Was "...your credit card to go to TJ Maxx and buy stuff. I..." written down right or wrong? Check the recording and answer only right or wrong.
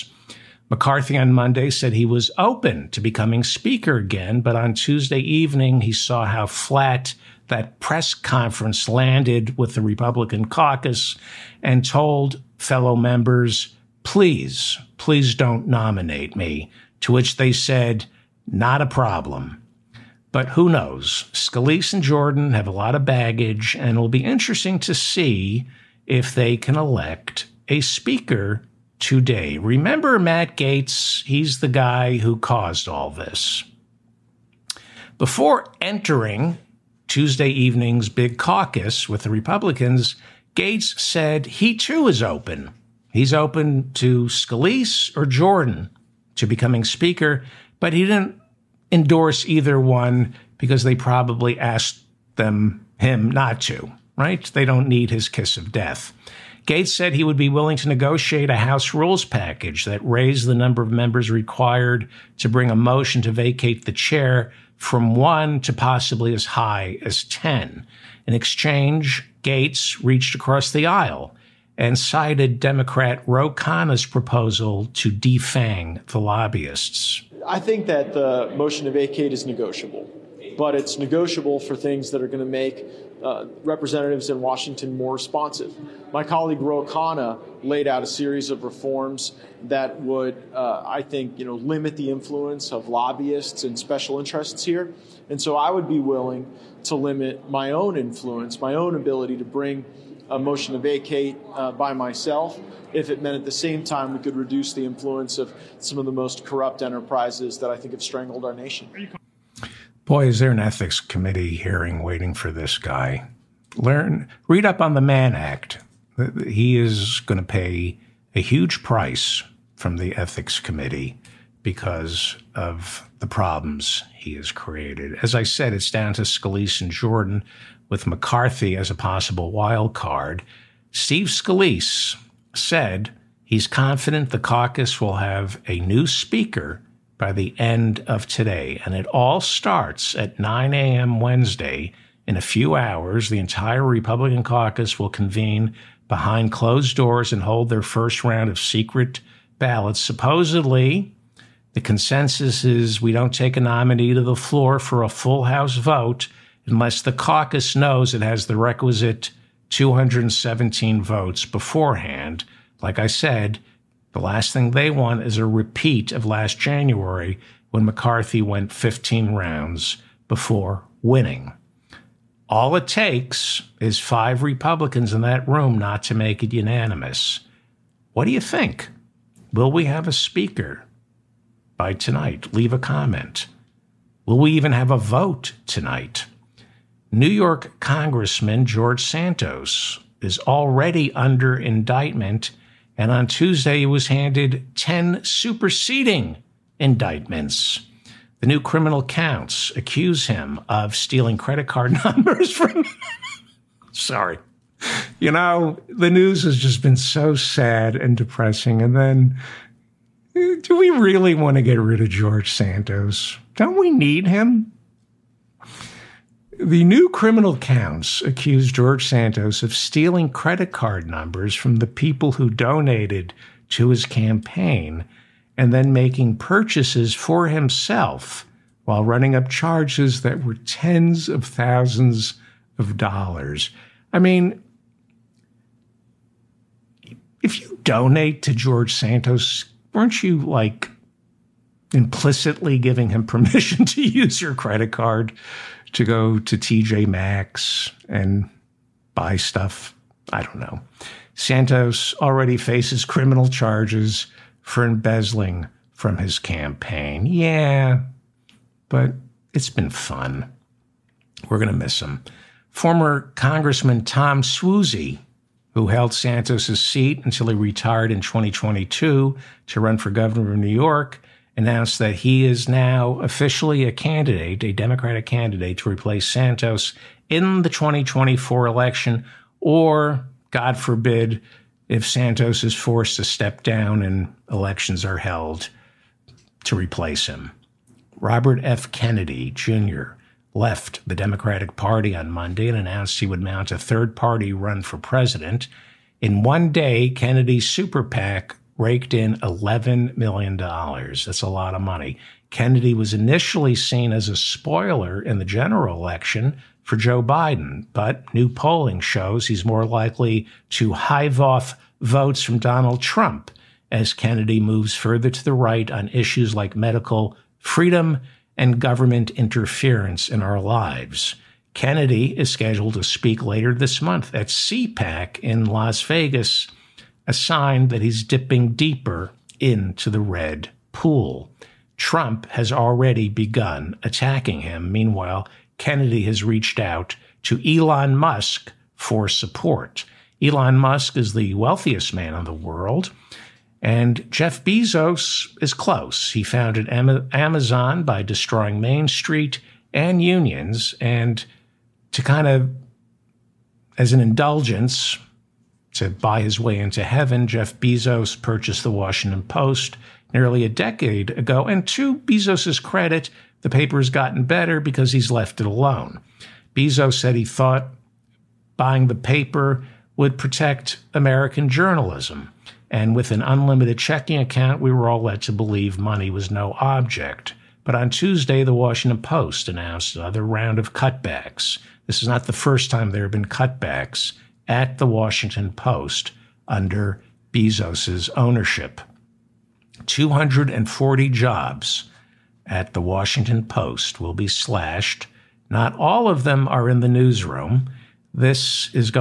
right.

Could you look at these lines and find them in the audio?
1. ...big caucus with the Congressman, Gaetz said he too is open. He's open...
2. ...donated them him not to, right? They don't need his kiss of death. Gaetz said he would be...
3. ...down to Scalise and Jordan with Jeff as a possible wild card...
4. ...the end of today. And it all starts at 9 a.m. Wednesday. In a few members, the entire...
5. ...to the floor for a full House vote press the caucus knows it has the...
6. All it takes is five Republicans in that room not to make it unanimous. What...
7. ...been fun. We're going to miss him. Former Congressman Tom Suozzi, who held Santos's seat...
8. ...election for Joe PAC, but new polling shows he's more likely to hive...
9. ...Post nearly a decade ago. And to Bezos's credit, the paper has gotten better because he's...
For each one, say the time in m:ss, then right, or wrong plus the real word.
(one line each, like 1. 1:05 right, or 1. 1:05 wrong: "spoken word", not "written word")
1. 0:38 wrong: "Republicans", not "Congressman"
2. 0:51 wrong: "asked", not "donated"
3. 2:05 wrong: "McCarthy", not "Jeff"
4. 2:17 wrong: "hours", not "members"
5. 2:34 wrong: "unless", not "press"
6. 2:52 right
7. 4:19 right
8. 5:05 wrong: "Biden", not "PAC"
9. 5:59 right.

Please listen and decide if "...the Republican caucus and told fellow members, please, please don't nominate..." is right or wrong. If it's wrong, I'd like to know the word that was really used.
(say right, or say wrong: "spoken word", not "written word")
right.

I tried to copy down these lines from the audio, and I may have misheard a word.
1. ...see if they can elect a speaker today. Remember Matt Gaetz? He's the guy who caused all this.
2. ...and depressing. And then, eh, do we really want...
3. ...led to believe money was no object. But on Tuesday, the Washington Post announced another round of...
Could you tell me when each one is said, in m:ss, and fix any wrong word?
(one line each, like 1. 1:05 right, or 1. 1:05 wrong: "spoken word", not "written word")
1. 0:24 right
2. 3:27 right
3. 6:15 right.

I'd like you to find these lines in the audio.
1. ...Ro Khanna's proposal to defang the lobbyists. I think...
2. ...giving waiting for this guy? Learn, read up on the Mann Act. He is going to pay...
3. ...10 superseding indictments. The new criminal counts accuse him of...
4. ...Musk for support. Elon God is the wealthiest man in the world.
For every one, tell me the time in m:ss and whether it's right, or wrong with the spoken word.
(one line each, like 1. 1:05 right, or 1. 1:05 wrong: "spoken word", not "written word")
1. 1:13 right
2. 1:51 wrong: "hearing", not "giving"
3. 3:14 right
4. 5:38 wrong: "Musk", not "God".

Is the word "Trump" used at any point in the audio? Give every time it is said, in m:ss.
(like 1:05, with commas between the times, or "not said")
5:13, 5:31.